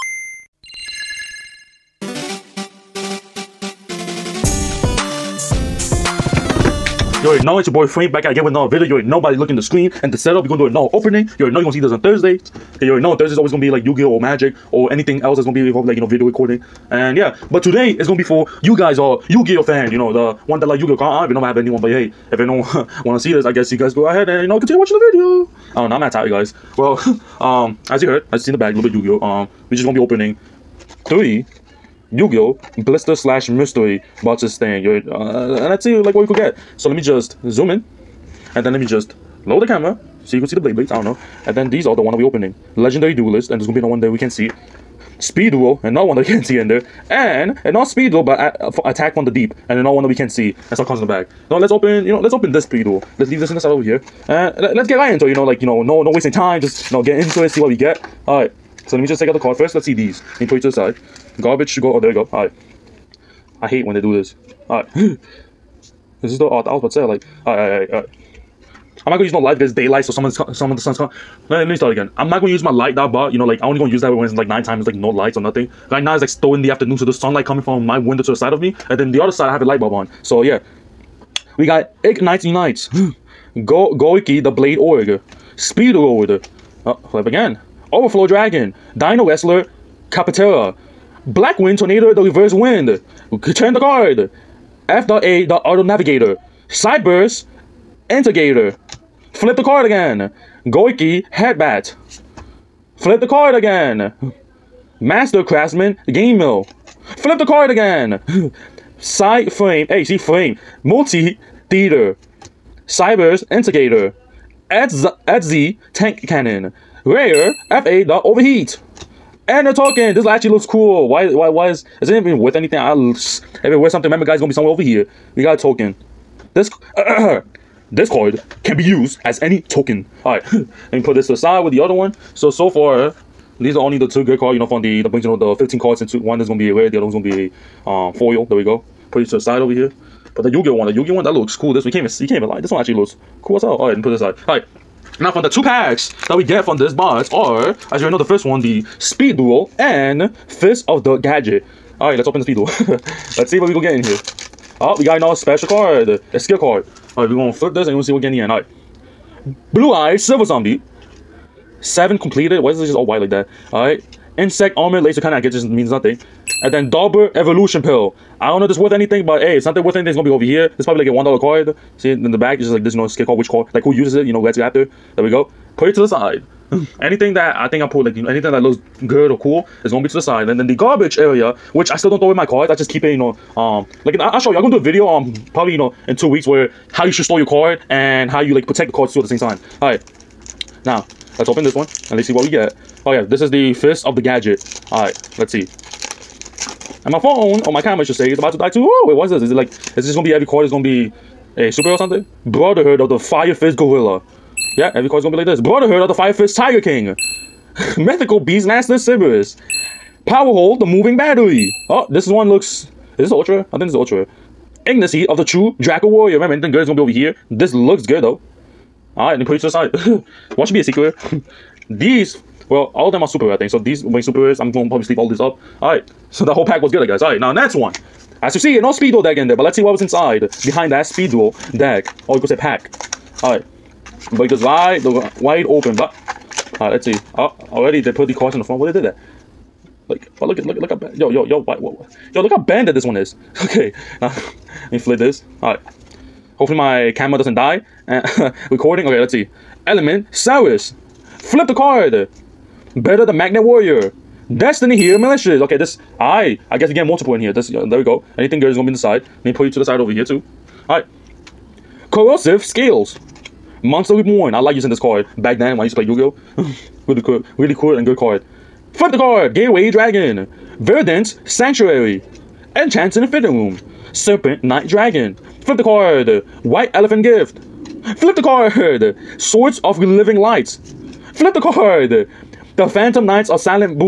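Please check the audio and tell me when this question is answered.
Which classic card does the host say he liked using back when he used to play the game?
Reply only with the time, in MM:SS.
04:23.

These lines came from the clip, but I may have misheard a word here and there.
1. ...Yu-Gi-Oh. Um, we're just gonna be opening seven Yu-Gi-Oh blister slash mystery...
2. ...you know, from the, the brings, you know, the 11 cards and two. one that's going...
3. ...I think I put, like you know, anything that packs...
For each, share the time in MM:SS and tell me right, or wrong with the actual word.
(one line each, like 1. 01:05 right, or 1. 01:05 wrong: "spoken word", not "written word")
1. 00:28 wrong: "three", not "seven"
2. 02:14 wrong: "15", not "11"
3. 02:57 wrong: "looks", not "packs".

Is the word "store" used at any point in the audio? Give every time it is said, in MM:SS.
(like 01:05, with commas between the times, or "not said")
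03:07.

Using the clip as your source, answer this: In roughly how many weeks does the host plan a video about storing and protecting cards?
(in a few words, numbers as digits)
2.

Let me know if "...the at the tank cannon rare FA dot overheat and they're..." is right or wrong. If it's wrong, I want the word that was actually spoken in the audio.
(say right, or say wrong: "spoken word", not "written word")
right.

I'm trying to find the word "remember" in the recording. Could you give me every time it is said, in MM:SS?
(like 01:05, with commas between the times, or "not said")
02:04, 03:36.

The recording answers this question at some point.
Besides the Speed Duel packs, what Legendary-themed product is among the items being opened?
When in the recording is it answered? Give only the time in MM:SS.
00:42.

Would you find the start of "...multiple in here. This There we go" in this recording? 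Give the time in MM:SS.
04:17.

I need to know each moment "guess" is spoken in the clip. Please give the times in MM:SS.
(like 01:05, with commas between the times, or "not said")
00:23, 02:45, 03:47, 04:16.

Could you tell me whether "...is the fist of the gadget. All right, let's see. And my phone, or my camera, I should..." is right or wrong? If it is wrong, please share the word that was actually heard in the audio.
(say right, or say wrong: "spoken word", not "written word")
right.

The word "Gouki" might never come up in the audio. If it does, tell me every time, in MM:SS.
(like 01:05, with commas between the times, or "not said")
01:23, 01:40.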